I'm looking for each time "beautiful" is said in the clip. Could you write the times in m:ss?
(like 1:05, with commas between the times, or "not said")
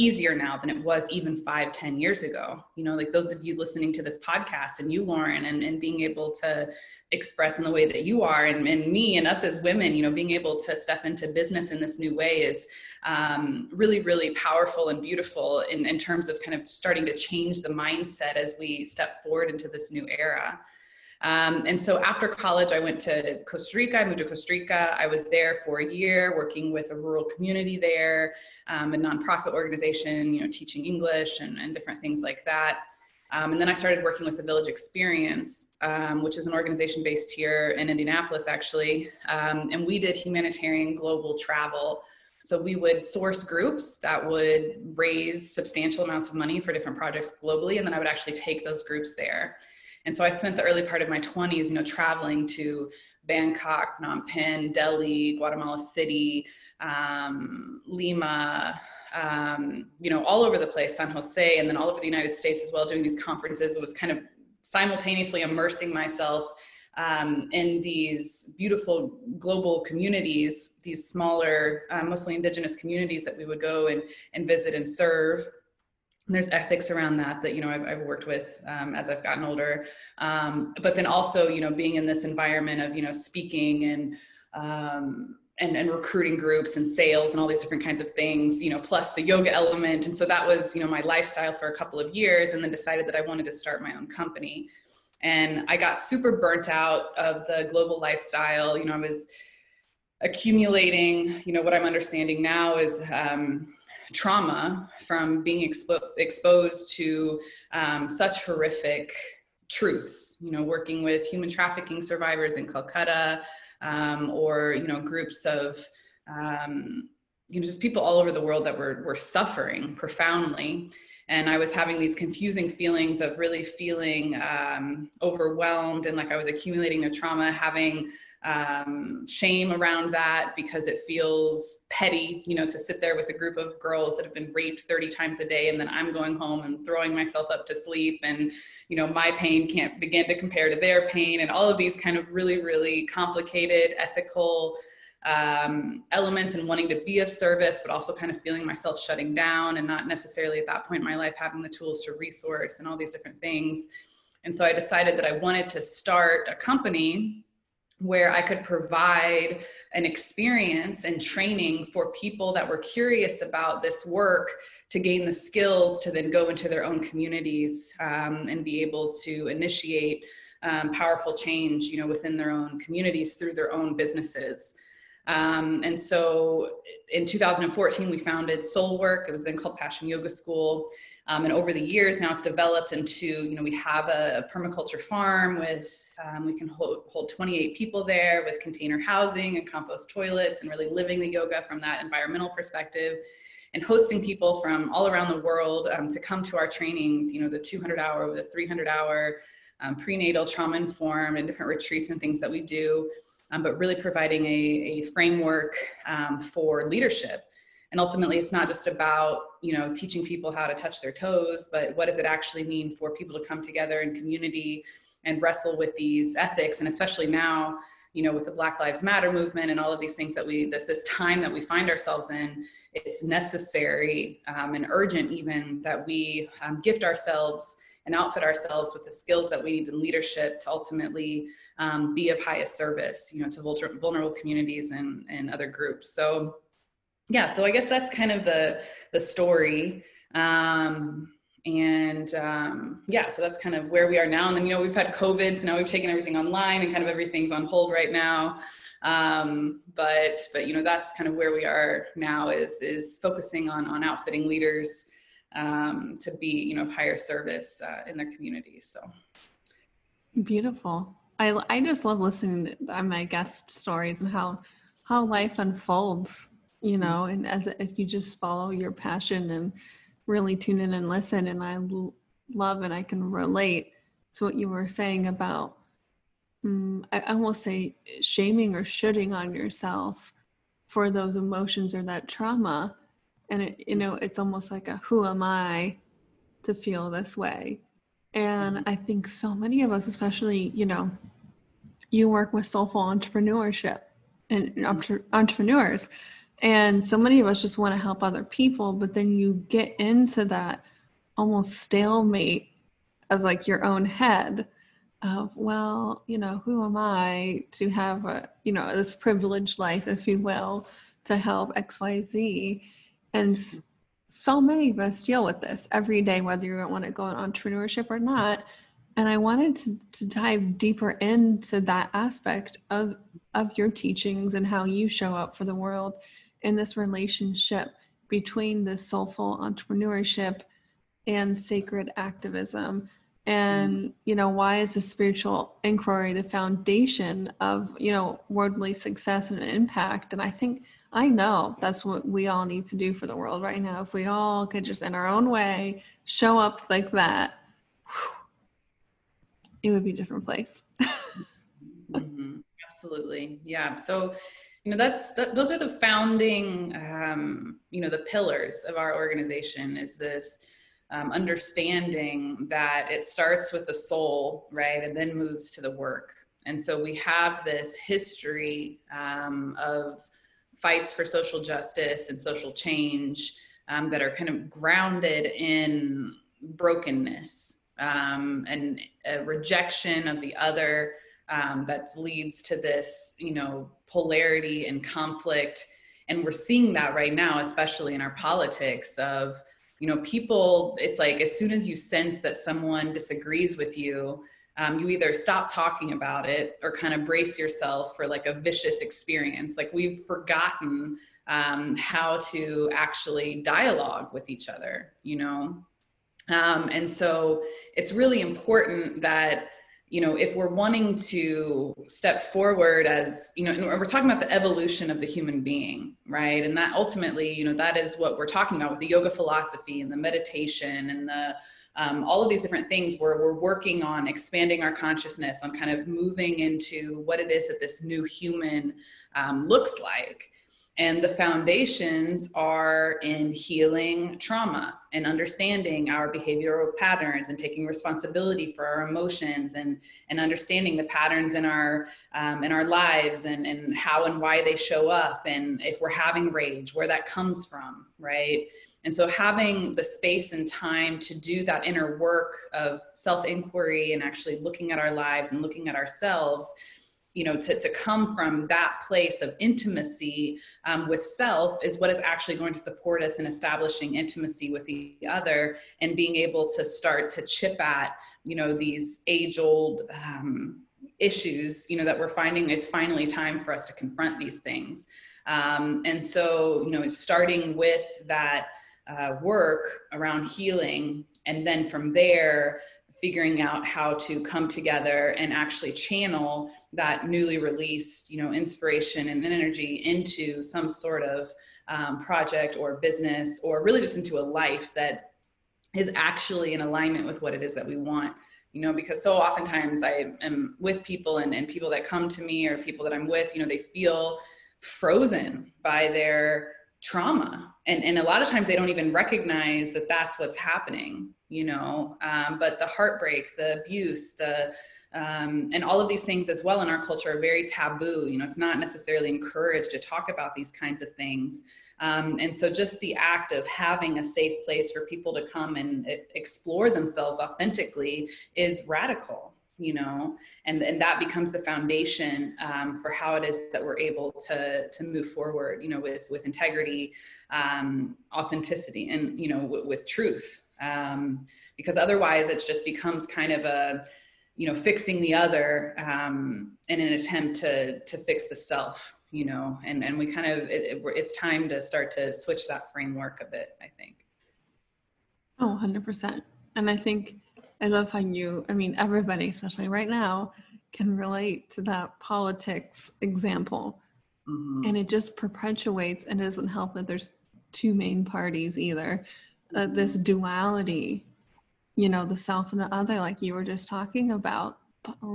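0:15, 1:08, 4:20.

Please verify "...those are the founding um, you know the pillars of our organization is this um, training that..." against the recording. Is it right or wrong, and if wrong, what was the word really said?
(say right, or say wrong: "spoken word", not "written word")
wrong: "understanding", not "training".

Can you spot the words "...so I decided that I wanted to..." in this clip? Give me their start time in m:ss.
2:34.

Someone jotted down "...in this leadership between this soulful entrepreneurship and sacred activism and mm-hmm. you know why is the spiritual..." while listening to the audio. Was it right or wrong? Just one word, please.
wrong.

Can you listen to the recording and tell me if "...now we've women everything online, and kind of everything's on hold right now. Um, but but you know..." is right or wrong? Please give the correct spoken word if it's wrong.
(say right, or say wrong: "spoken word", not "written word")
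wrong: "taken", not "women".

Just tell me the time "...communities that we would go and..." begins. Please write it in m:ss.
1:12.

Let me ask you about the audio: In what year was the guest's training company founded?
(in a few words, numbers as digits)
2014.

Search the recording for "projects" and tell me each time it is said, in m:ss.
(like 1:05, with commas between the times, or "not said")
0:46, 8:12.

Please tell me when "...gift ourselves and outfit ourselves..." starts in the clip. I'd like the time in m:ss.
3:46.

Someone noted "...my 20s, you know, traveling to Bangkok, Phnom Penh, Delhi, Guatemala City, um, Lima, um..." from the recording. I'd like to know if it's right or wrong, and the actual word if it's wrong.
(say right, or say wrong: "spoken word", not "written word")
right.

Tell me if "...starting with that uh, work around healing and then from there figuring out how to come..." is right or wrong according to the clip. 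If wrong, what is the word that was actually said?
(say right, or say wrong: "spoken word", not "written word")
right.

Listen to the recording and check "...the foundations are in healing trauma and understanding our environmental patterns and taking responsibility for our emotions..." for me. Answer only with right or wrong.
wrong.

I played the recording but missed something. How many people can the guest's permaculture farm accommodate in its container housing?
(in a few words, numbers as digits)
28.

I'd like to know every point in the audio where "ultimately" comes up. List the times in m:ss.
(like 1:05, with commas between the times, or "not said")
3:27, 3:50, 6:56.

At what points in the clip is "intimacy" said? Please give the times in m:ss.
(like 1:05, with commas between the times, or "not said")
7:39, 7:44.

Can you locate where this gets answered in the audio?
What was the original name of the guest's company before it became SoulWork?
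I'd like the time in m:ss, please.
2:59.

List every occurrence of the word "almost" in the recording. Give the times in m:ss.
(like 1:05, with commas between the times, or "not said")
4:44, 5:01.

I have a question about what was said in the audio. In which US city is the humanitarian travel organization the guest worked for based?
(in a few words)
Indianapolis.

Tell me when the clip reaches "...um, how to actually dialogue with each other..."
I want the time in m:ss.
6:41.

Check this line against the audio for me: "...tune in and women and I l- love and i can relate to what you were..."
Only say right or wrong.
wrong.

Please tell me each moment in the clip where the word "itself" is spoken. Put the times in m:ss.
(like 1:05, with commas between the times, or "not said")
not said.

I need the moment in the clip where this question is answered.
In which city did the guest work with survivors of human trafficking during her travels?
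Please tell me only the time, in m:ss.
1:52.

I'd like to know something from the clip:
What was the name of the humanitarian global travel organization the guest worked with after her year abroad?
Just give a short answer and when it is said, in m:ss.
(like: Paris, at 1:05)
the Village Experience, at 0:34.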